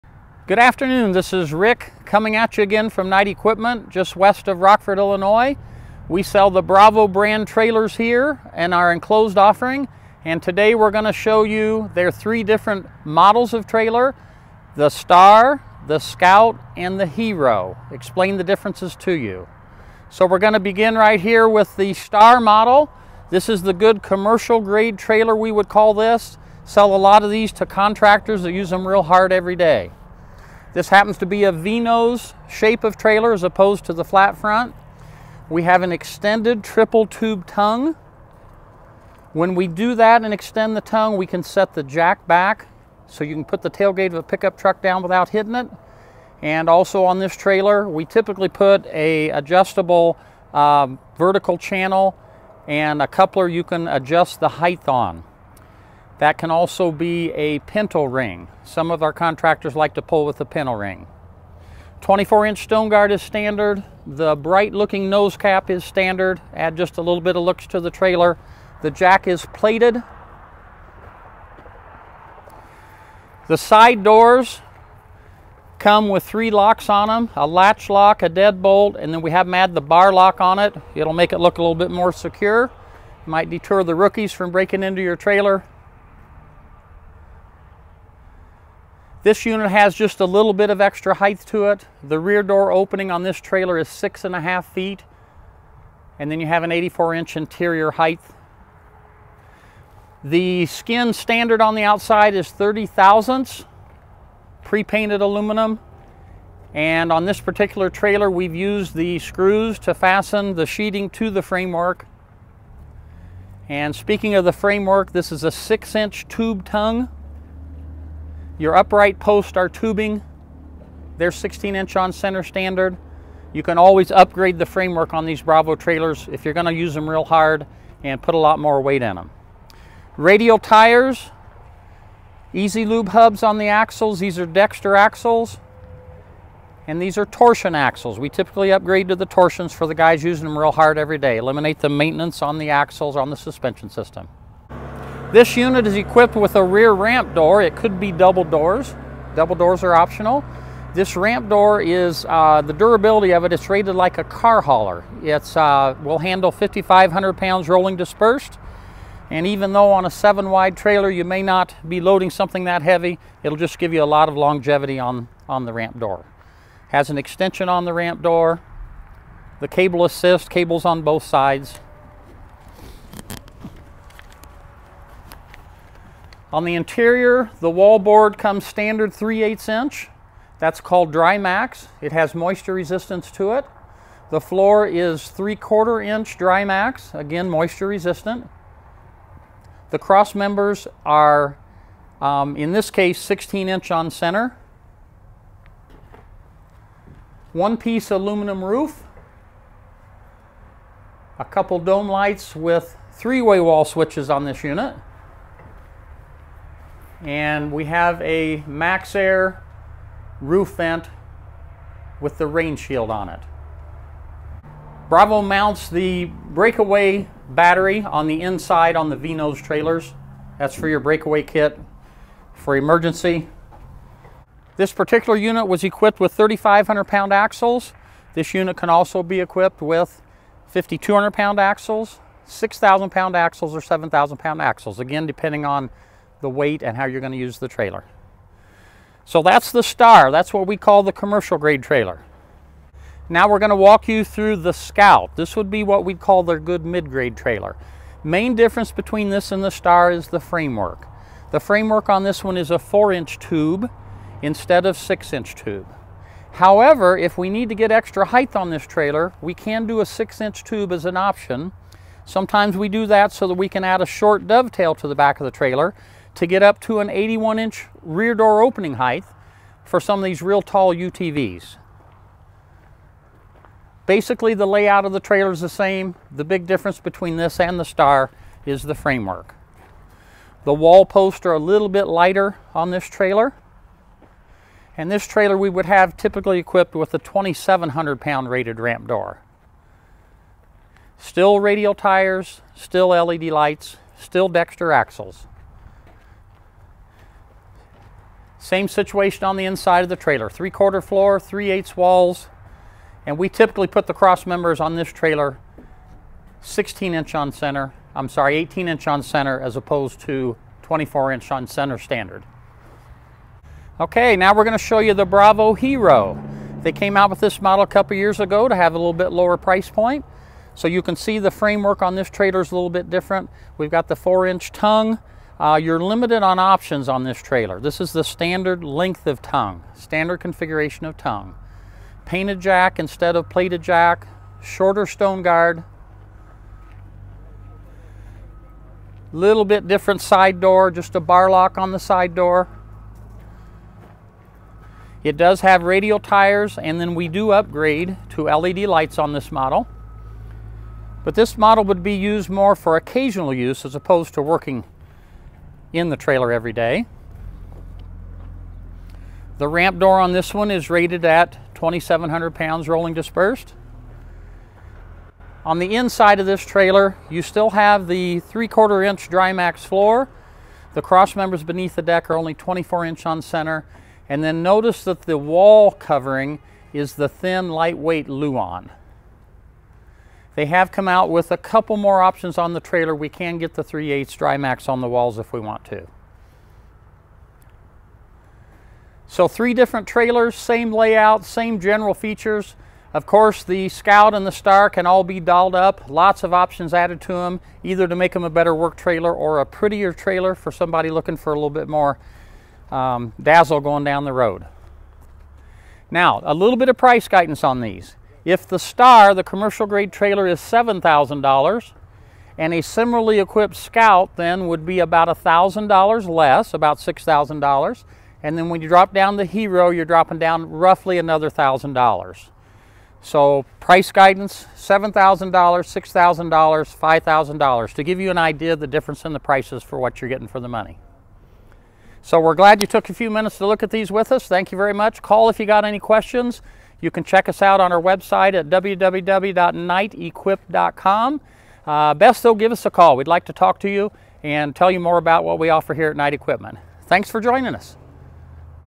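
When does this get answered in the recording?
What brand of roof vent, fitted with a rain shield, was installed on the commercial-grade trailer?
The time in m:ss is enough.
3:28.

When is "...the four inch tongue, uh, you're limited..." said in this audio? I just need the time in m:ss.
5:24.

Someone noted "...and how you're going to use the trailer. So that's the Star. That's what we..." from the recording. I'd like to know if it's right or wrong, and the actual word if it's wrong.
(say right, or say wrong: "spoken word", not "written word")
right.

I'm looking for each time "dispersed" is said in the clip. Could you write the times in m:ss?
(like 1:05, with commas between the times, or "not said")
2:37, 6:03.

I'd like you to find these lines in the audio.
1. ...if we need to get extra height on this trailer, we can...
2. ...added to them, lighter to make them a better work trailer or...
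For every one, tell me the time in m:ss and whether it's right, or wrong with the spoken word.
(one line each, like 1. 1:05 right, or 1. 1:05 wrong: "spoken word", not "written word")
1. 4:17 right
2. 6:36 wrong: "either", not "lighter".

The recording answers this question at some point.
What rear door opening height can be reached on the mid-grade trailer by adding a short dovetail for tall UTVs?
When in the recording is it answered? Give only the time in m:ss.
4:27.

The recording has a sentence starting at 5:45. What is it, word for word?
It does have radial tires and then we do upgrade to LED lights on this model.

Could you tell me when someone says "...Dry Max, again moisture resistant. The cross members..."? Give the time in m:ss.
3:06.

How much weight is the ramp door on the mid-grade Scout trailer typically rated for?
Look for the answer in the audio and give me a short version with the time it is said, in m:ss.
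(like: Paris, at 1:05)
2,700 pounds, at 4:47.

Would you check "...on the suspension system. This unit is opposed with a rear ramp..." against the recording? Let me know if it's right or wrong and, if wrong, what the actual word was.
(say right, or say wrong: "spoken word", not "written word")
wrong: "equipped", not "opposed".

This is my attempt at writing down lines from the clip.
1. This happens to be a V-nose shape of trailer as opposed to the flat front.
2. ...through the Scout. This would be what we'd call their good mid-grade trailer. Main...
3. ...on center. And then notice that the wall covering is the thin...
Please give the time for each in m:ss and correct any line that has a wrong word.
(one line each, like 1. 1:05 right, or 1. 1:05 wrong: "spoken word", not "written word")
1. 0:30 right
2. 4:04 right
3. 6:13 right.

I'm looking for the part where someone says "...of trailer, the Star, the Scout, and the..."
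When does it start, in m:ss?
0:13.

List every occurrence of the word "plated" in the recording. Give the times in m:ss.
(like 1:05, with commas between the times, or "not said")
1:09, 5:33.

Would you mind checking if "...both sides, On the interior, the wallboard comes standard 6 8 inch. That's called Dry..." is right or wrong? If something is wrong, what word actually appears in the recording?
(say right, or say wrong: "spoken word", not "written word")
wrong: "3", not "6".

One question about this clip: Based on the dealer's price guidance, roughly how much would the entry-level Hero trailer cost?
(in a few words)
$5,000.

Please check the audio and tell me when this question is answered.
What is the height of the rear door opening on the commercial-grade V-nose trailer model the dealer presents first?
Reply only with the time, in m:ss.
1:33.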